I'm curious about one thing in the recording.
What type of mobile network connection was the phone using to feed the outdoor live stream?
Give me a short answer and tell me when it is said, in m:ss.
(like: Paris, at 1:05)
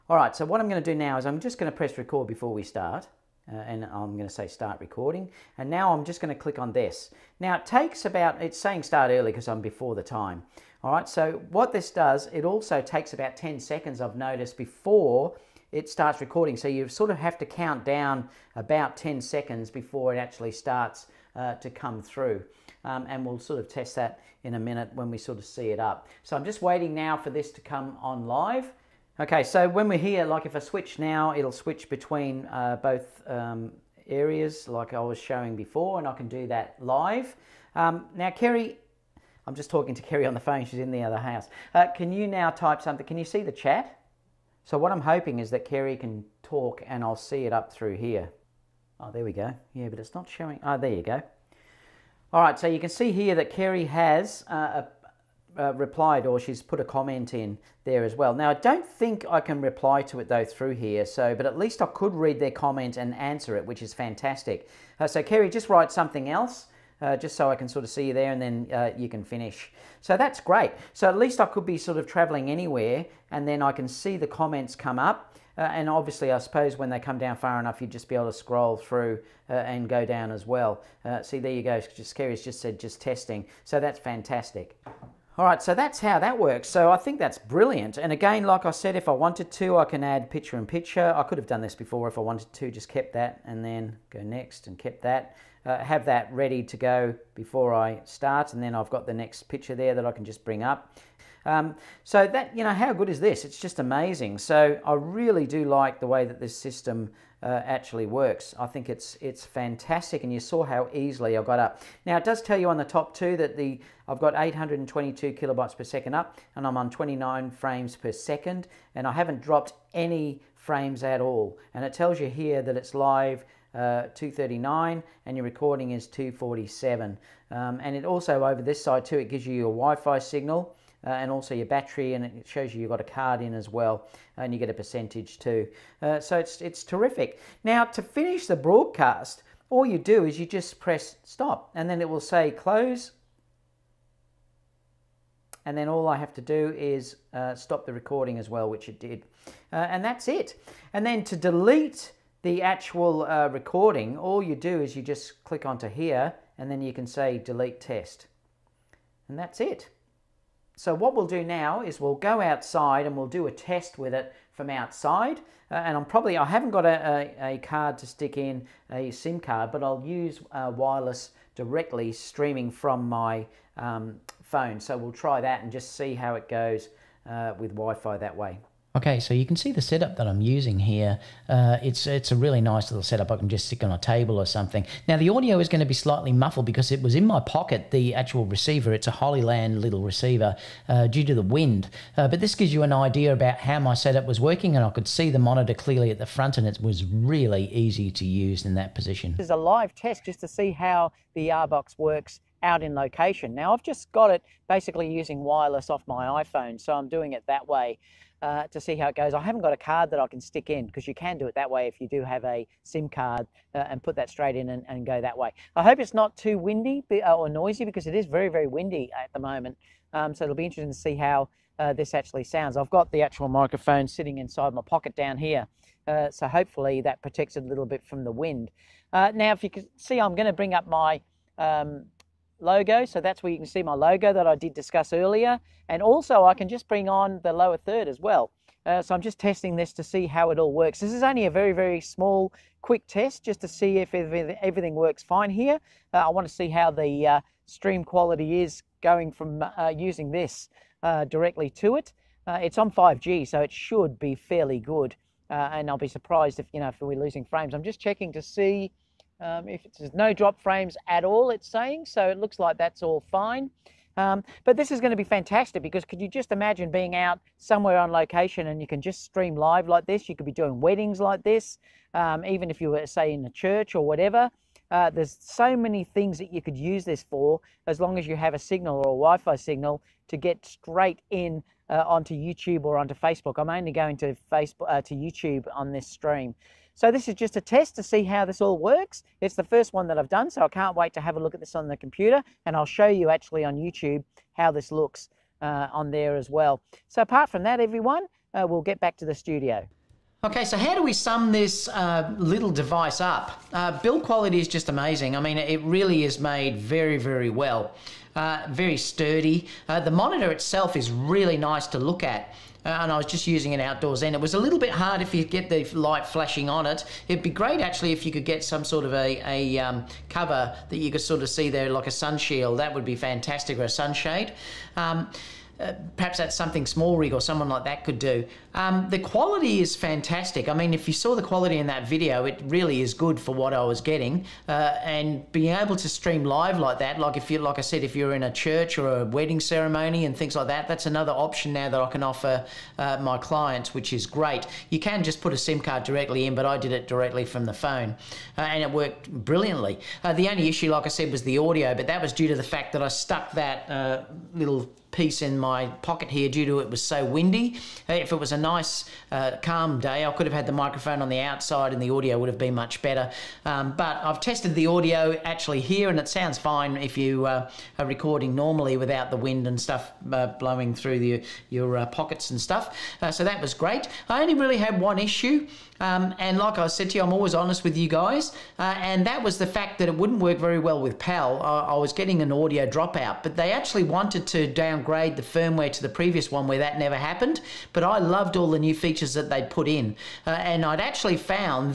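5G, at 4:12.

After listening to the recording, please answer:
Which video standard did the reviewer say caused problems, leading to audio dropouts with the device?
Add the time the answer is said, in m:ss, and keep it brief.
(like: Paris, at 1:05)
PAL, at 6:21.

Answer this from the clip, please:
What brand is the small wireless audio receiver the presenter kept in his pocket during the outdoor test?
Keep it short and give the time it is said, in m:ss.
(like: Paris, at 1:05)
Hollyland, at 3:09.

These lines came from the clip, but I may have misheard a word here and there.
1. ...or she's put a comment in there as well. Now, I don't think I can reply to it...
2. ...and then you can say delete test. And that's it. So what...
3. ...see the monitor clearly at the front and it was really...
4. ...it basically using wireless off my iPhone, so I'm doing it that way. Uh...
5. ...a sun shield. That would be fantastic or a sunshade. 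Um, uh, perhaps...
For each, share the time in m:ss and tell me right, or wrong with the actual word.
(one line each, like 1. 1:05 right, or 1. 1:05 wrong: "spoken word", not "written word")
1. 0:56 right
2. 2:36 right
3. 3:15 right
4. 3:24 right
5. 5:22 right.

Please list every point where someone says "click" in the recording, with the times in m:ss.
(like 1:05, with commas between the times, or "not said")
0:06, 2:35.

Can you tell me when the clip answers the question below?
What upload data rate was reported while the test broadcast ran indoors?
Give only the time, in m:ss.
1:54.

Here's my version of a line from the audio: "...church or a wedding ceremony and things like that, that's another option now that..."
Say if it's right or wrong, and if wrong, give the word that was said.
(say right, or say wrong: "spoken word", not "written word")
right.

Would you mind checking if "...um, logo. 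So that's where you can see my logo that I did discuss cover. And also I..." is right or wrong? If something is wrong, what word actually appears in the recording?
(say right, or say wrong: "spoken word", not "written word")
wrong: "earlier", not "cover".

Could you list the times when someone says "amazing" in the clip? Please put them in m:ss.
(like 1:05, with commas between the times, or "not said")
1:43, 5:04.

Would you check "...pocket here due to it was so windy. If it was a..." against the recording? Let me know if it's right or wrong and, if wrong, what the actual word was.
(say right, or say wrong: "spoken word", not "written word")
right.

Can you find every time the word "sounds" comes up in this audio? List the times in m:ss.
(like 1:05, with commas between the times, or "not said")
3:42, 6:06.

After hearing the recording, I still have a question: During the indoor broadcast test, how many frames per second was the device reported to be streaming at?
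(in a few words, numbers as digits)
29.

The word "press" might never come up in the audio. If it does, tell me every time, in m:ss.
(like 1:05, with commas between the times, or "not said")
0:01, 2:20.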